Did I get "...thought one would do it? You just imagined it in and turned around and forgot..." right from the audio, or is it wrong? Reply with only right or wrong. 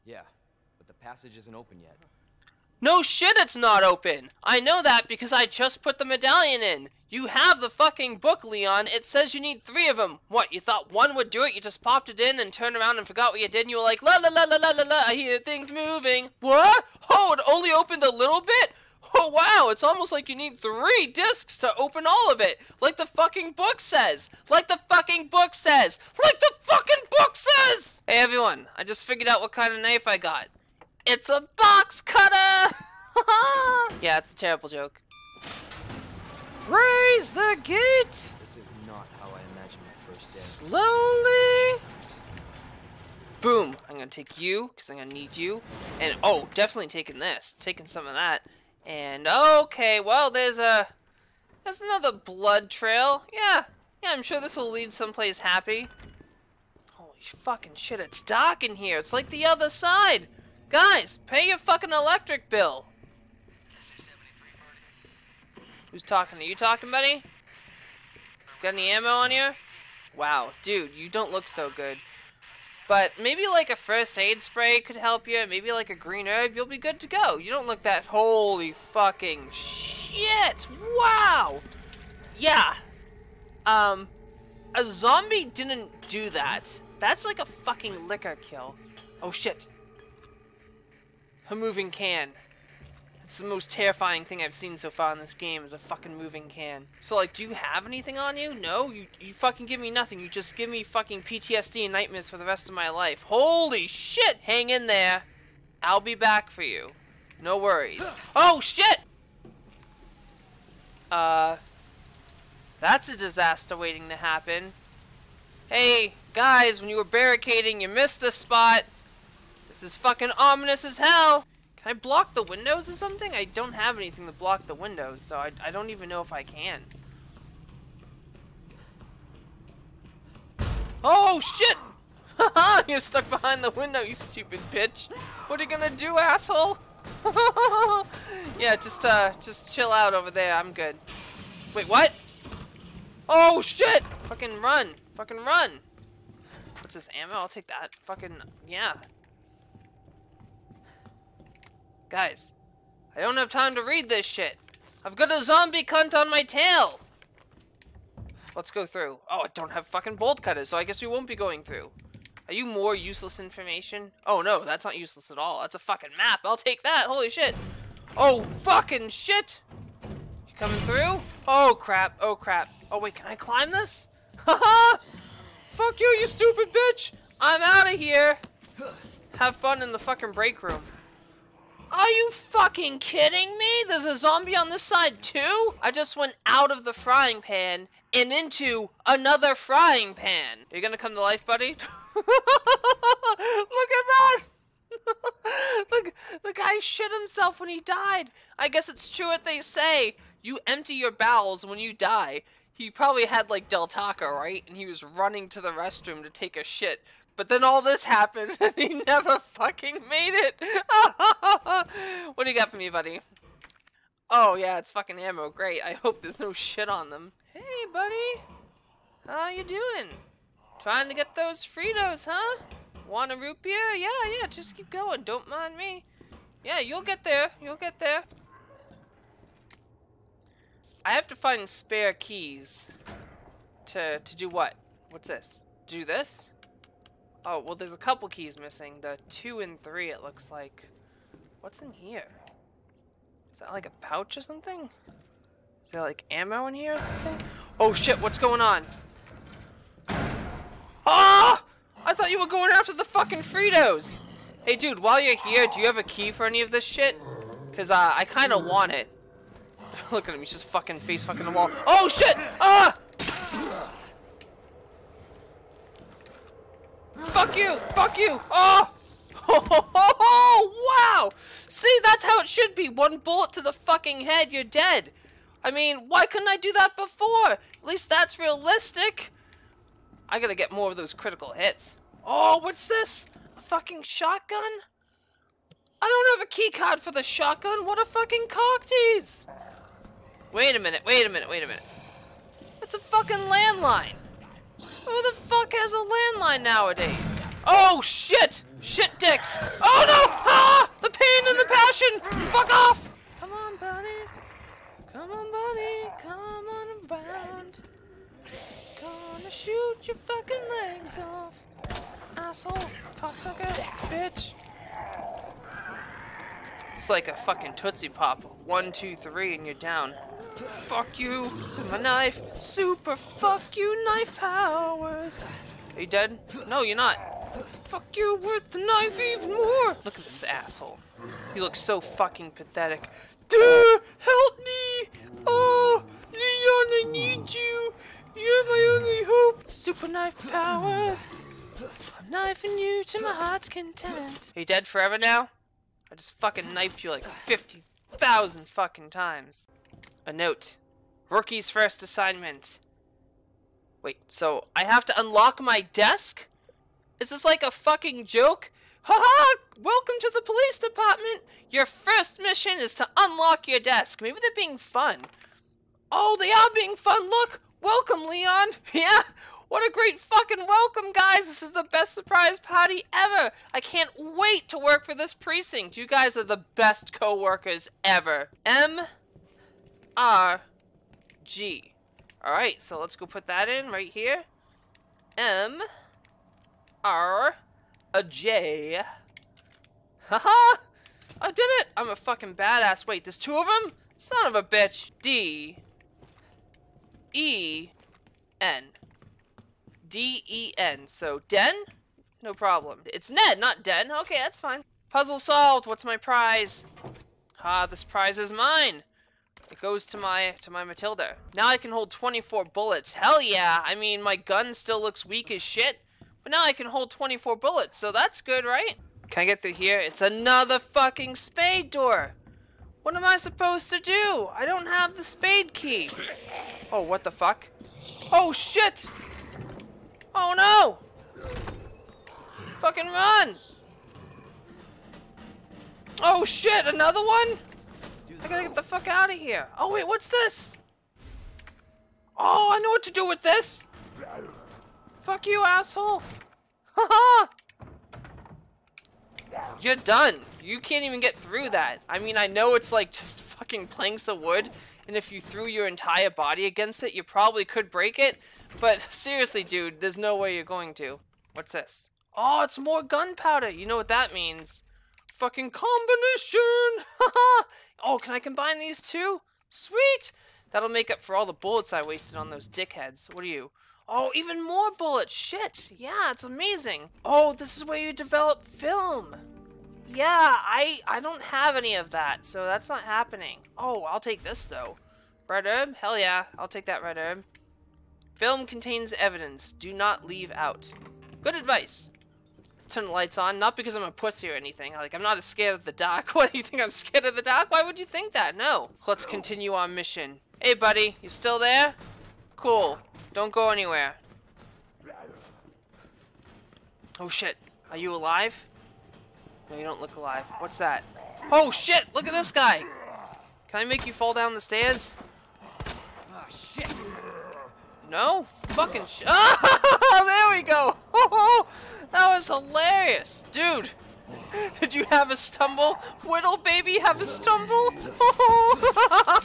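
wrong.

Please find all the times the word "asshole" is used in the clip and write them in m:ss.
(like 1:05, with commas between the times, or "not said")
2:16, 5:12, 5:30, 7:25.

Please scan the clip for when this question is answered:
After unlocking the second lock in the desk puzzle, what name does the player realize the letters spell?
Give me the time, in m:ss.
6:43.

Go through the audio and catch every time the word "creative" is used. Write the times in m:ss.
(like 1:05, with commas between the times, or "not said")
not said.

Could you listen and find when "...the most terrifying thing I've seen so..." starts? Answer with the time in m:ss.
1:33.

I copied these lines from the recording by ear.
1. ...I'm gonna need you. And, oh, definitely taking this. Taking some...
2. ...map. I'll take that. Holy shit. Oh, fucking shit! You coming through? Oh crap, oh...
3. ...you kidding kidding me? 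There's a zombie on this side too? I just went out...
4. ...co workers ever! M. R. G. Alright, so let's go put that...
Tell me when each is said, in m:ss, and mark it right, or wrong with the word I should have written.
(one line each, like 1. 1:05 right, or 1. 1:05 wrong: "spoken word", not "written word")
1. 0:44 right
2. 2:46 right
3. 3:02 wrong: "fucking", not "kidding"
4. 6:17 right.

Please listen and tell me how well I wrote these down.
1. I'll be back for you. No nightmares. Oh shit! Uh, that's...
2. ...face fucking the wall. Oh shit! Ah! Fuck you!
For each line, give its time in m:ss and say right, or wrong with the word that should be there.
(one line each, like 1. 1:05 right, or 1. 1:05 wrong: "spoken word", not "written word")
1. 1:45 wrong: "worries", not "nightmares"
2. 4:21 right.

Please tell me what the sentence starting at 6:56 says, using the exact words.
But now I can hold 24 bullets, so that's good, right?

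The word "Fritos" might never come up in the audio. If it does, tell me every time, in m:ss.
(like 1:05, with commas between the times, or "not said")
3:41, 4:13.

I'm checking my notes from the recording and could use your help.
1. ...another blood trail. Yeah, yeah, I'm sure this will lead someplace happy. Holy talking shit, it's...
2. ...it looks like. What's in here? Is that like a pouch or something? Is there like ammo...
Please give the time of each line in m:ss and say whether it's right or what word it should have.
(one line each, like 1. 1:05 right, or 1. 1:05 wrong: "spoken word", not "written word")
1. 0:51 wrong: "fucking", not "talking"
2. 4:00 right.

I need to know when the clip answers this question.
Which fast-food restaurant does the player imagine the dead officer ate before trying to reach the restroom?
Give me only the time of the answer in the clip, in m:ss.
3:23.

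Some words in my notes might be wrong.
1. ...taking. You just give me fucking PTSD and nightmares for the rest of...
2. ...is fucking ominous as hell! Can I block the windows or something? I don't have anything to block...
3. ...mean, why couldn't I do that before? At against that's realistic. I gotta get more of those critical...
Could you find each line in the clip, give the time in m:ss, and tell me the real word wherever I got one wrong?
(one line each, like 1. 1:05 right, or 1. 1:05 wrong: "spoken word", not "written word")
1. 1:39 wrong: "nothing", not "taking"
2. 1:59 right
3. 4:35 wrong: "least", not "against".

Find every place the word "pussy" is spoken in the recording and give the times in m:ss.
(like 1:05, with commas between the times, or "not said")
8:14.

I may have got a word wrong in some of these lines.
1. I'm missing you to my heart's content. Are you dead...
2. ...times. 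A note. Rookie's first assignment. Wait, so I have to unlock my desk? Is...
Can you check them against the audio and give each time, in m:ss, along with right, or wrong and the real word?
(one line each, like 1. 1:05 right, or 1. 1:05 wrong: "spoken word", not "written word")
1. 5:42 wrong: "knifing", not "missing"
2. 5:49 right.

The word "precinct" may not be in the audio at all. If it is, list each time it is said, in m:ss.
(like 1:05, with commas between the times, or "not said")
6:15.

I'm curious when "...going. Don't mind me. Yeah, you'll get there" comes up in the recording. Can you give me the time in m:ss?
3:44.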